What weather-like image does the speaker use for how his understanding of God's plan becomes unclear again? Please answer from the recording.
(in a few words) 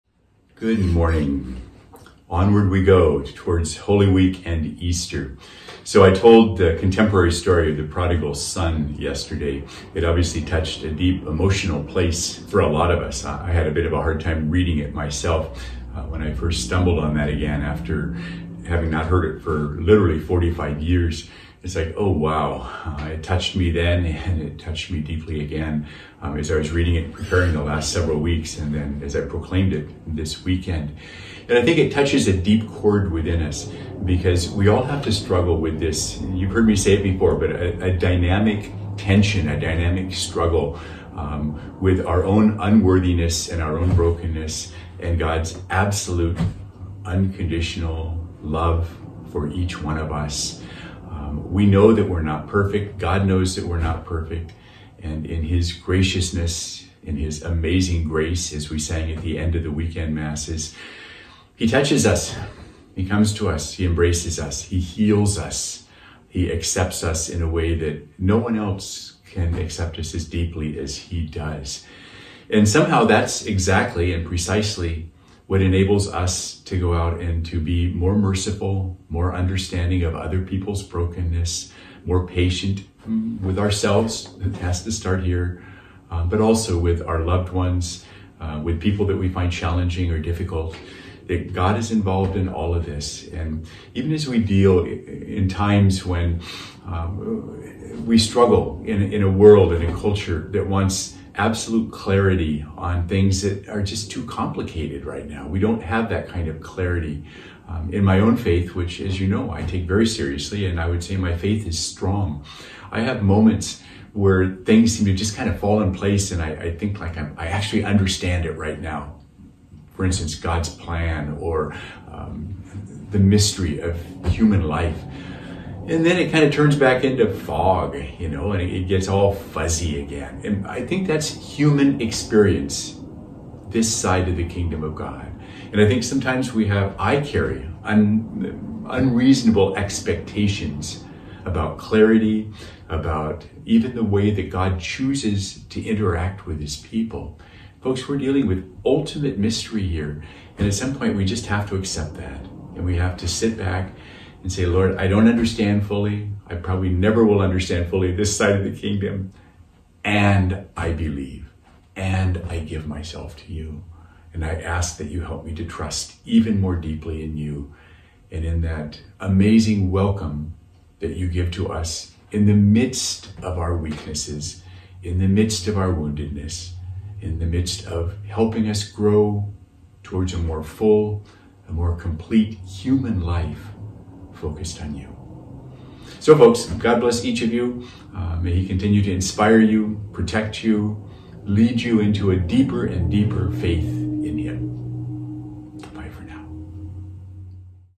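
Fog.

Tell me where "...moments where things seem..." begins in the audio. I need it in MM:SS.
01:53.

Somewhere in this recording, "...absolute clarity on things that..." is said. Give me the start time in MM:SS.
01:41.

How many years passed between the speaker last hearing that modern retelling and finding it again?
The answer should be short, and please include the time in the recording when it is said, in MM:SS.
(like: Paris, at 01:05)
45, at 00:20.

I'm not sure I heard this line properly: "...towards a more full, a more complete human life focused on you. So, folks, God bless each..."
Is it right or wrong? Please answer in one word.
right.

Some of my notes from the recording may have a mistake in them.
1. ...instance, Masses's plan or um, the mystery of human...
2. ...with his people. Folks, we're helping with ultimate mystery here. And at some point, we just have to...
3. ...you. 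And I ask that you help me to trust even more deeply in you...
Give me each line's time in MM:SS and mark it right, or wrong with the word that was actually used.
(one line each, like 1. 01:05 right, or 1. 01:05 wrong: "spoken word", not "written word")
1. 02:00 wrong: "God", not "Masses"
2. 02:26 wrong: "dealing", not "helping"
3. 02:43 right.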